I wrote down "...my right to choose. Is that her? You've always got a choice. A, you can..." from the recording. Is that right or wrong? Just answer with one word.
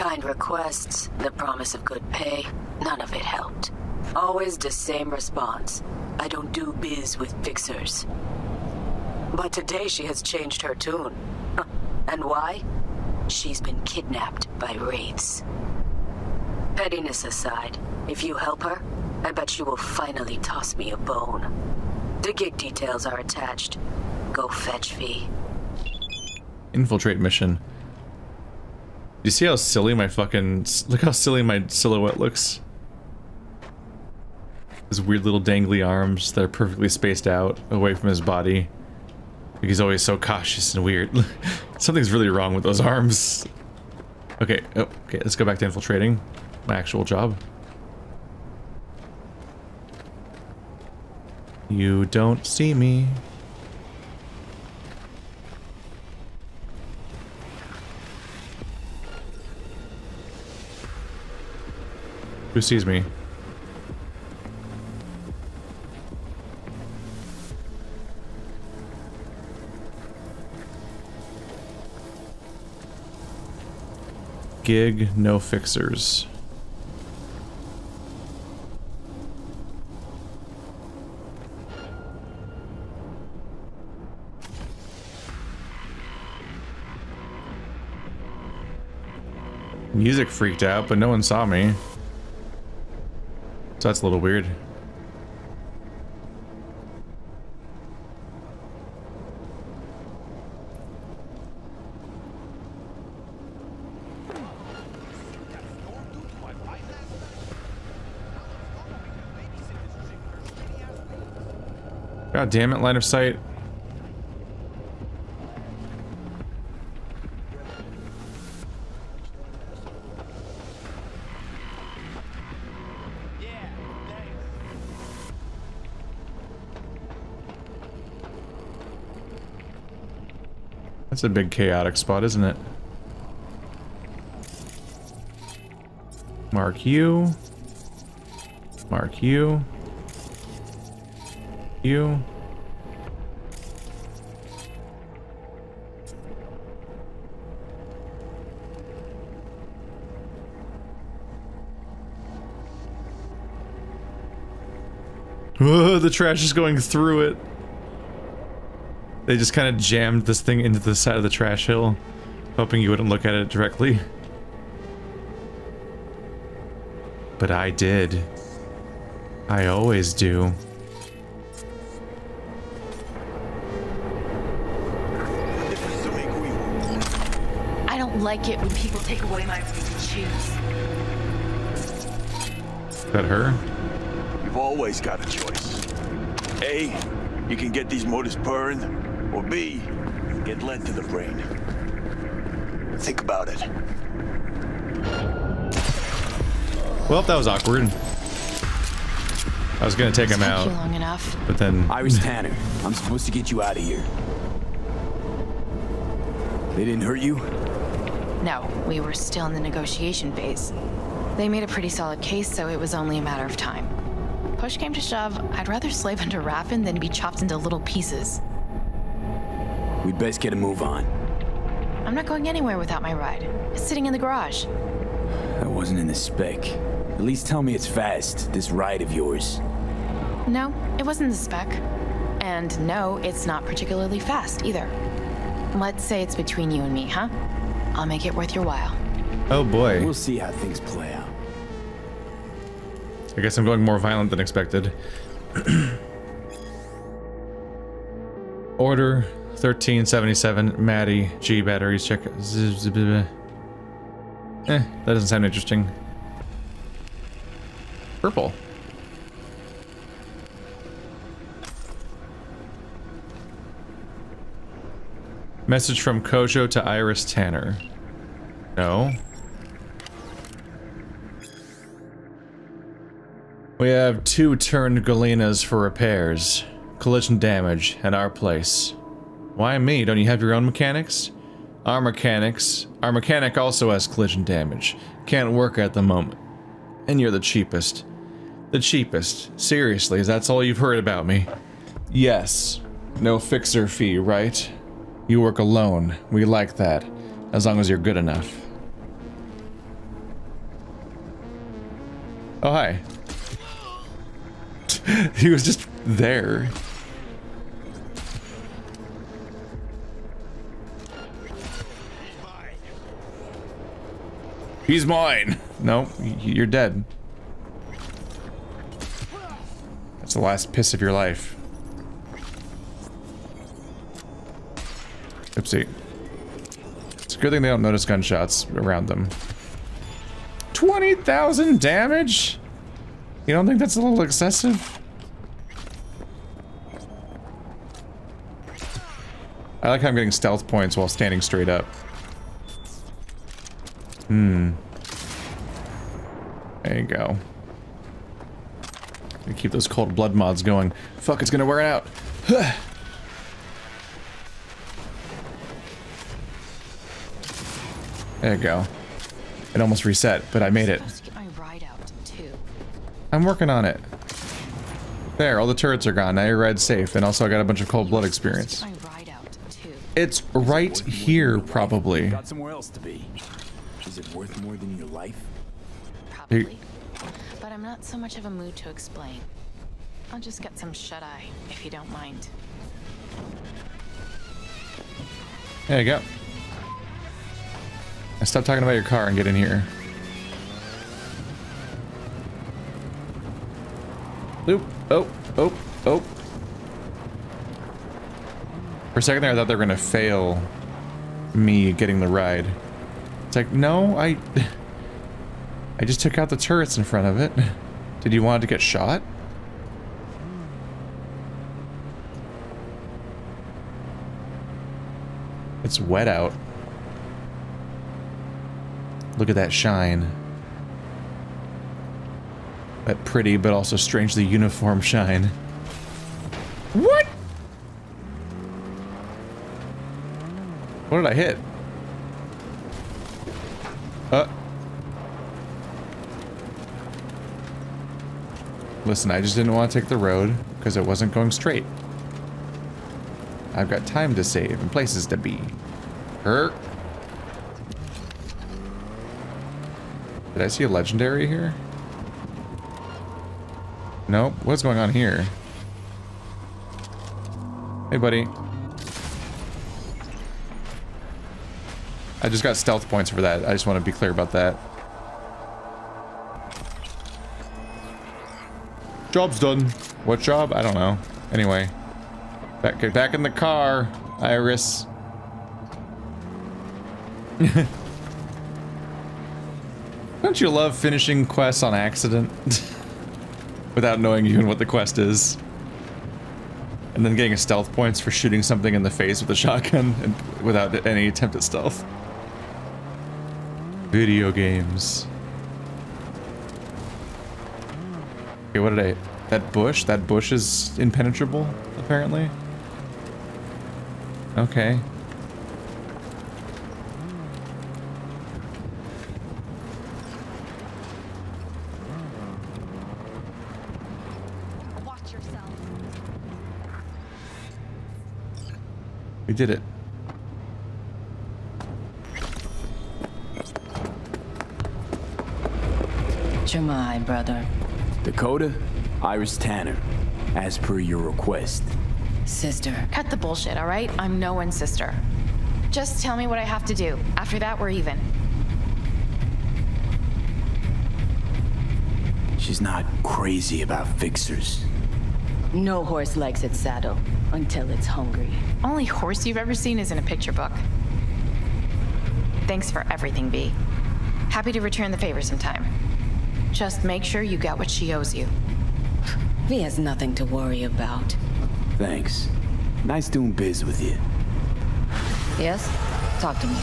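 right.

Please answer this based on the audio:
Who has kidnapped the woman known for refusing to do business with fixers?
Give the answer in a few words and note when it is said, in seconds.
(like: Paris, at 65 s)
Wraiths, at 14 s.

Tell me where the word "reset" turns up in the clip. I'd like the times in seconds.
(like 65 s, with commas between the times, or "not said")
360 s.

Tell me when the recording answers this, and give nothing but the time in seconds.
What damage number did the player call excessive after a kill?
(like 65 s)
330 s.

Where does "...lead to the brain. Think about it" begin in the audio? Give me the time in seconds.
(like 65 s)
190 s.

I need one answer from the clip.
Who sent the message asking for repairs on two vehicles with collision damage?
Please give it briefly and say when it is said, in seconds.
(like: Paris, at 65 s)
Kojo, at 266 s.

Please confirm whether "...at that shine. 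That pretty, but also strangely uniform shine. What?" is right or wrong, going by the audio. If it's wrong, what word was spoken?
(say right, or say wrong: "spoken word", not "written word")
right.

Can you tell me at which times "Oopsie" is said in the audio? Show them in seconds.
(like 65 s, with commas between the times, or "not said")
325 s.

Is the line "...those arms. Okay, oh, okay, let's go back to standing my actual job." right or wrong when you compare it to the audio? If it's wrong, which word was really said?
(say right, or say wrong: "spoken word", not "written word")
wrong: "infiltrating", not "standing".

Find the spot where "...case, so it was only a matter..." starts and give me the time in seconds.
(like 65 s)
212 s.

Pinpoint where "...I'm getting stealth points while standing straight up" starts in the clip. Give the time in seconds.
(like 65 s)
340 s.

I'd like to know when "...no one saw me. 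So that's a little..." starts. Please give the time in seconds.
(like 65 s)
90 s.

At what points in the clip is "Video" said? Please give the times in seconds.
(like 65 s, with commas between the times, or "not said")
494 s.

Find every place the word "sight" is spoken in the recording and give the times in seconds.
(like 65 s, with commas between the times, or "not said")
113 s.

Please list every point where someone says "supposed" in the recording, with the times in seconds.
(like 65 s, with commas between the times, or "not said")
202 s.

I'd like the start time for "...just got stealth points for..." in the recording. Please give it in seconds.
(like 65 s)
462 s.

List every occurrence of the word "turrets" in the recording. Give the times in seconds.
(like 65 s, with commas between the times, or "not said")
365 s, 406 s.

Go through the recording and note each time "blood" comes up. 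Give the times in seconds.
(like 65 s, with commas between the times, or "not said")
350 s, 368 s.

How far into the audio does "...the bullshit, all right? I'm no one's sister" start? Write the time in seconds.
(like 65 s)
533 s.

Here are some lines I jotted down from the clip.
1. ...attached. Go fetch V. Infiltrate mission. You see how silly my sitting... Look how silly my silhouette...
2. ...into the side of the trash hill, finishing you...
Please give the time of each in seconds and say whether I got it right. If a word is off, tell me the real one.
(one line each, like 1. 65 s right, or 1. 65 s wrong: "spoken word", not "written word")
1. 23 s wrong: "fucking", not "sitting"
2. 160 s wrong: "hoping", not "finishing".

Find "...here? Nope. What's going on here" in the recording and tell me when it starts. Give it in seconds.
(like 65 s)
451 s.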